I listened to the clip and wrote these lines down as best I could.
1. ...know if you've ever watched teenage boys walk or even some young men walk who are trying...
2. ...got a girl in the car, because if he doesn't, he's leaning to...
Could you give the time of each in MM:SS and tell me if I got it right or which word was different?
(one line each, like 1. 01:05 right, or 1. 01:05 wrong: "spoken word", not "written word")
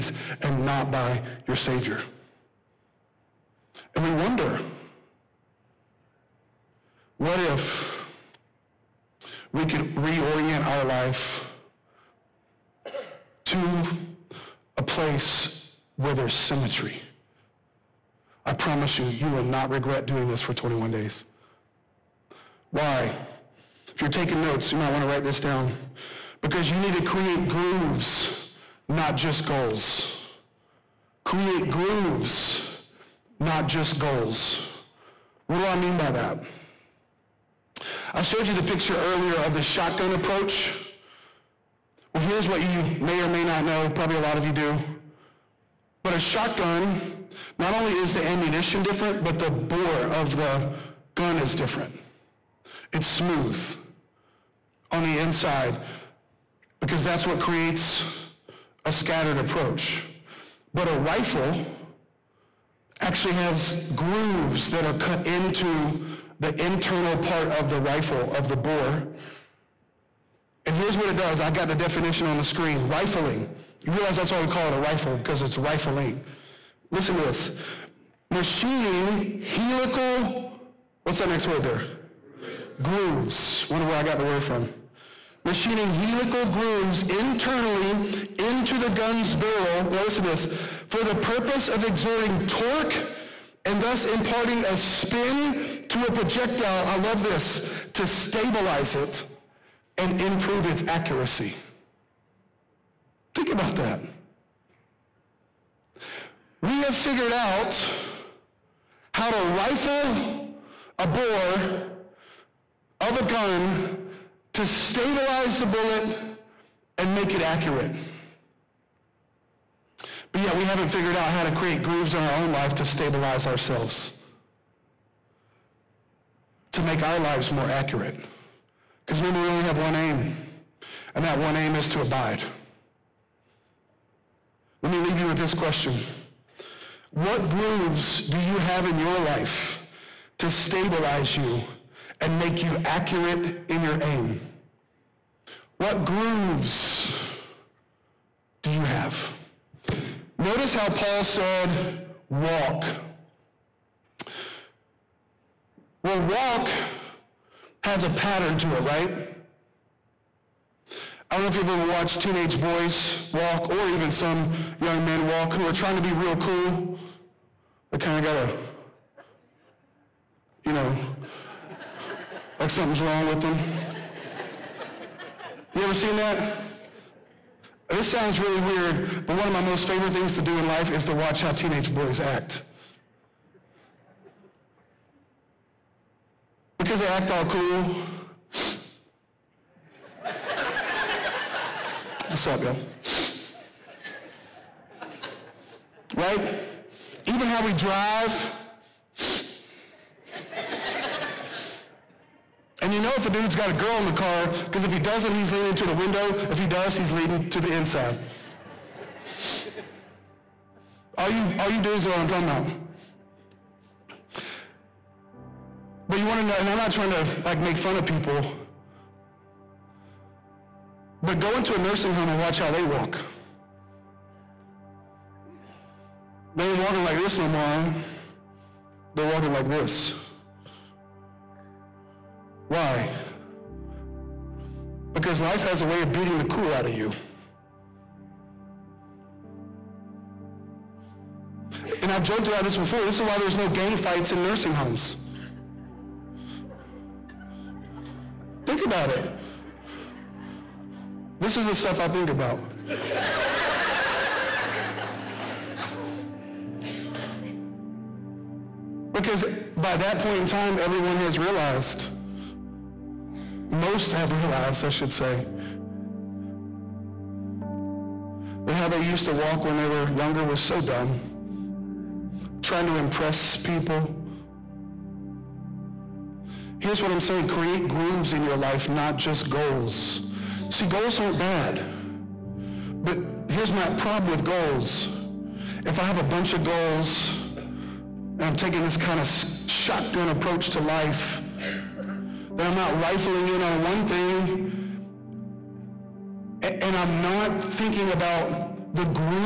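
1. 02:41 right
2. 03:23 right.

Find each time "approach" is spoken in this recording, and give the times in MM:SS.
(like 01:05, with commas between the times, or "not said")
00:40, 00:59, 04:50.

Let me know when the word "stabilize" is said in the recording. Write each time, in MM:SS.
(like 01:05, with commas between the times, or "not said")
01:38, 01:54, 02:02, 02:20.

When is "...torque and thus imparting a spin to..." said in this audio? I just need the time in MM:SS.
01:32.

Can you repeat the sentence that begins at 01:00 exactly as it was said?
But a rifle actually has grooves that are cut into the internal part of the rifle of the bore.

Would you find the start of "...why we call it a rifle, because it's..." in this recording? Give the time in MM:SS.
01:14.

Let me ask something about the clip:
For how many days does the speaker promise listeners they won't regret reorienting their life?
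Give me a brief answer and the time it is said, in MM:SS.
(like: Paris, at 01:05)
21, at 00:20.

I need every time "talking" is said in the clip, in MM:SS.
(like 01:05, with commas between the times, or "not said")
03:32.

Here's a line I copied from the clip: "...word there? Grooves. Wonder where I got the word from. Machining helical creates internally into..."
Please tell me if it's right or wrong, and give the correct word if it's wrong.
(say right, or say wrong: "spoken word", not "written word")
wrong: "grooves", not "creates".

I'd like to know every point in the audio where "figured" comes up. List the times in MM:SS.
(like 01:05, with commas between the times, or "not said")
01:46, 02:00.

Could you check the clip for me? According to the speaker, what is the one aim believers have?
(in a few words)
To abide.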